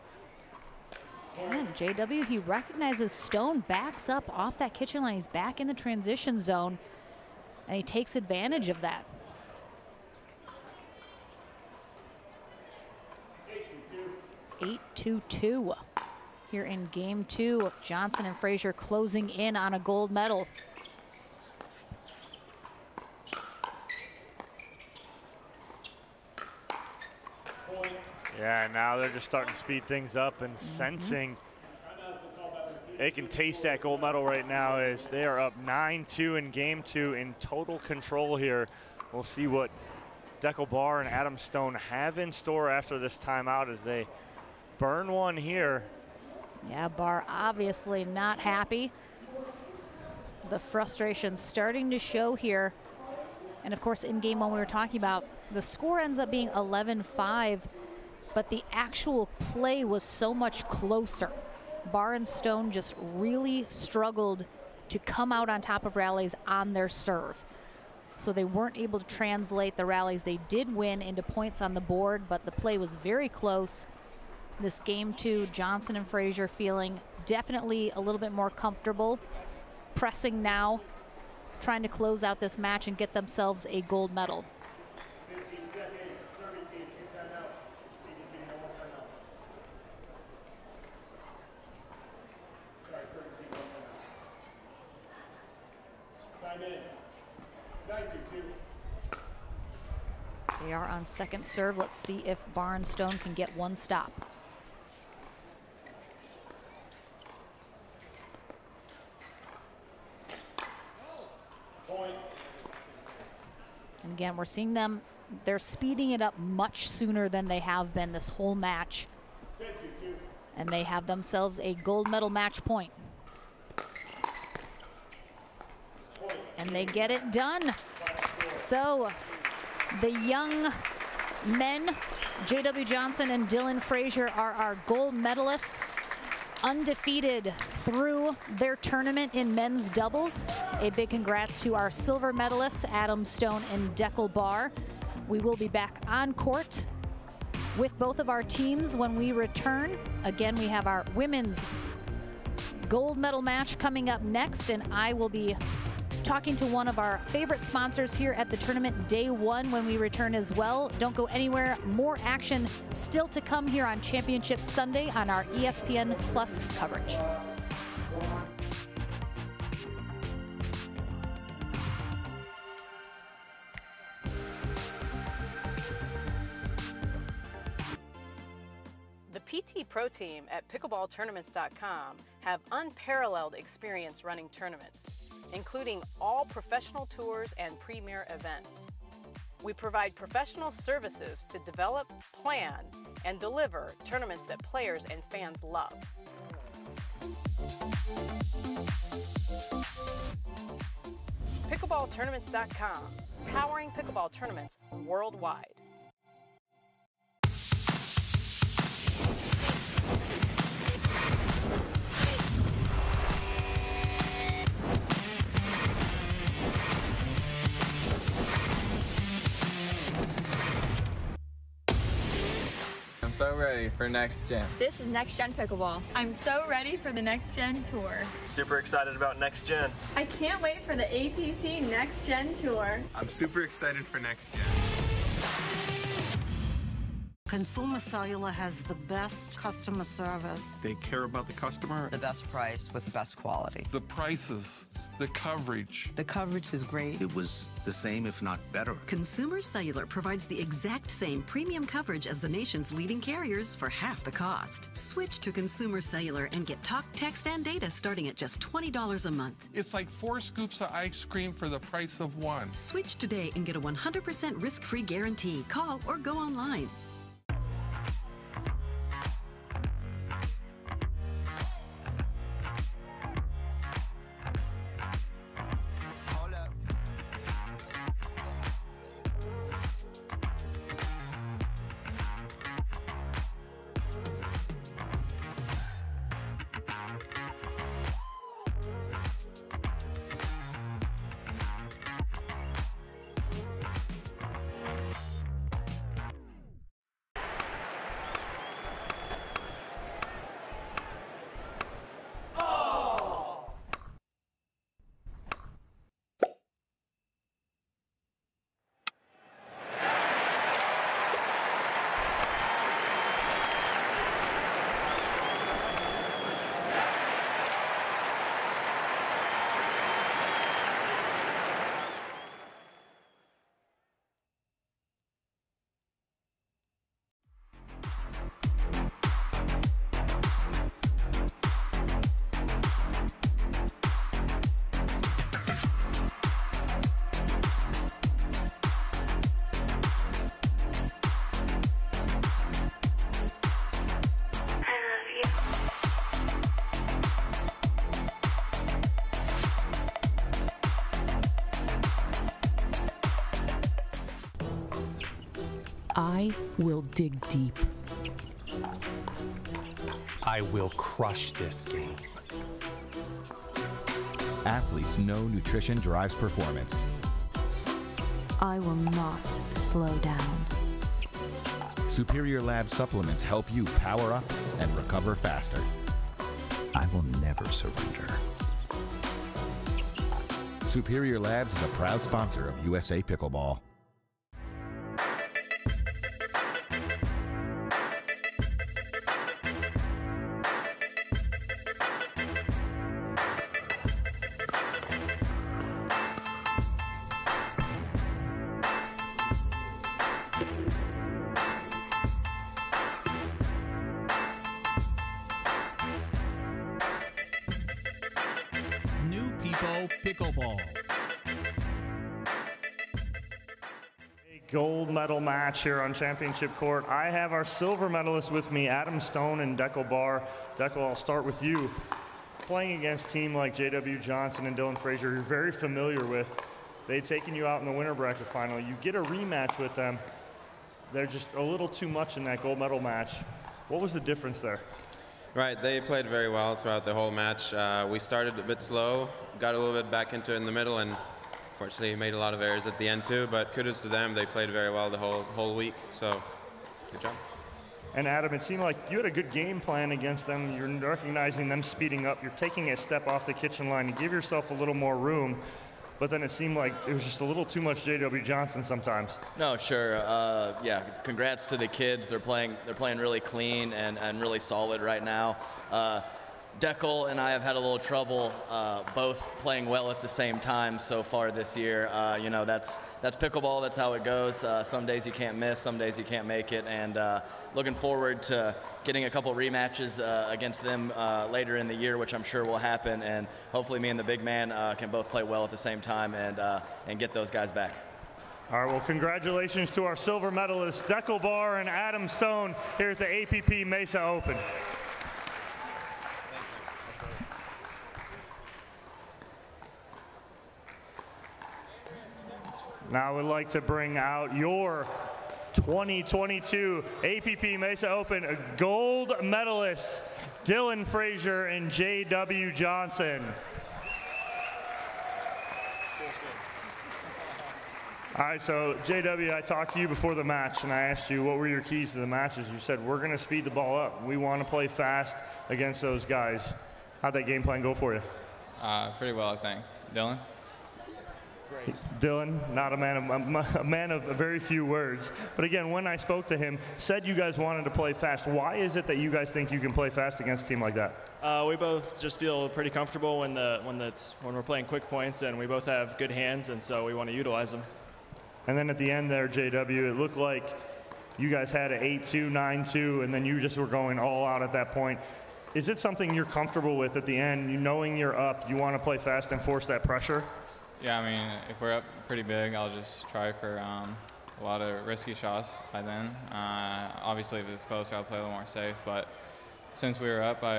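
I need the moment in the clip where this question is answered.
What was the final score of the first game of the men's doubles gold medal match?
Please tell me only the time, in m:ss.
0:56.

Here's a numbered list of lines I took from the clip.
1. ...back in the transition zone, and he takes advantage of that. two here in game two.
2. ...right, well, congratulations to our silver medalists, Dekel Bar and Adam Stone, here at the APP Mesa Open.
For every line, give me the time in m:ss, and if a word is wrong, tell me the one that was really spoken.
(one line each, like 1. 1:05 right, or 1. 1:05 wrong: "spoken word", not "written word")
1. 0:05 right
2. 8:08 right.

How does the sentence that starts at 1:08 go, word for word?
So they weren't able to translate the rallies they did win into points on the board, but the play was very close.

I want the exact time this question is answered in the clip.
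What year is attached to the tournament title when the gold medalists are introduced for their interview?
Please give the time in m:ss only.
8:25.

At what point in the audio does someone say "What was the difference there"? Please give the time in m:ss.
7:13.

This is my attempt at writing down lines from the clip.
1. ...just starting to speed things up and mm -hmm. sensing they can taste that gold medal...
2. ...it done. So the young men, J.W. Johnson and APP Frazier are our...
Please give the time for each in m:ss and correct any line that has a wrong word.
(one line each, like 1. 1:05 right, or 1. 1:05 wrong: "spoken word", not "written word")
1. 0:29 right
2. 2:07 wrong: "Dylan", not "APP".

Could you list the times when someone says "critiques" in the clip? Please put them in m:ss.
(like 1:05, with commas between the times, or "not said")
not said.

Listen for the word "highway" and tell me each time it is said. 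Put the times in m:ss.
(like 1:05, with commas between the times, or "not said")
not said.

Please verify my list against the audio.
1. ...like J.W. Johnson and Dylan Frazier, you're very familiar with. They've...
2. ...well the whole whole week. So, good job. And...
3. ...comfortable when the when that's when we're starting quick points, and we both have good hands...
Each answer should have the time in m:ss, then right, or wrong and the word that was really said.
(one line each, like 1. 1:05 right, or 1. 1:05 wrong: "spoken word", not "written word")
1. 7:03 right
2. 7:24 right
3. 9:02 wrong: "playing", not "starting".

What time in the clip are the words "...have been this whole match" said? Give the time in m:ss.
1:57.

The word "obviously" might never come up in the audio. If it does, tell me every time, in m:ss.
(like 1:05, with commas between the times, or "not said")
0:47, 9:27.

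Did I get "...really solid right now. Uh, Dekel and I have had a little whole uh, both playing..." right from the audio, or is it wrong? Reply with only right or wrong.
wrong.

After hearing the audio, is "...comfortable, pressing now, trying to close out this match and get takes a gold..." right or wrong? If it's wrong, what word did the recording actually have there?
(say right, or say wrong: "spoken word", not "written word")
wrong: "themselves", not "takes".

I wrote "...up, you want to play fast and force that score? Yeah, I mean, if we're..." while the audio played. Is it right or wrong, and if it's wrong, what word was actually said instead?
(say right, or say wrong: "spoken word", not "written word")
wrong: "pressure", not "score".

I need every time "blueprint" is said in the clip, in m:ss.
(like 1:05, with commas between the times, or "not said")
not said.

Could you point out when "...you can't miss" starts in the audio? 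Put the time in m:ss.
7:55.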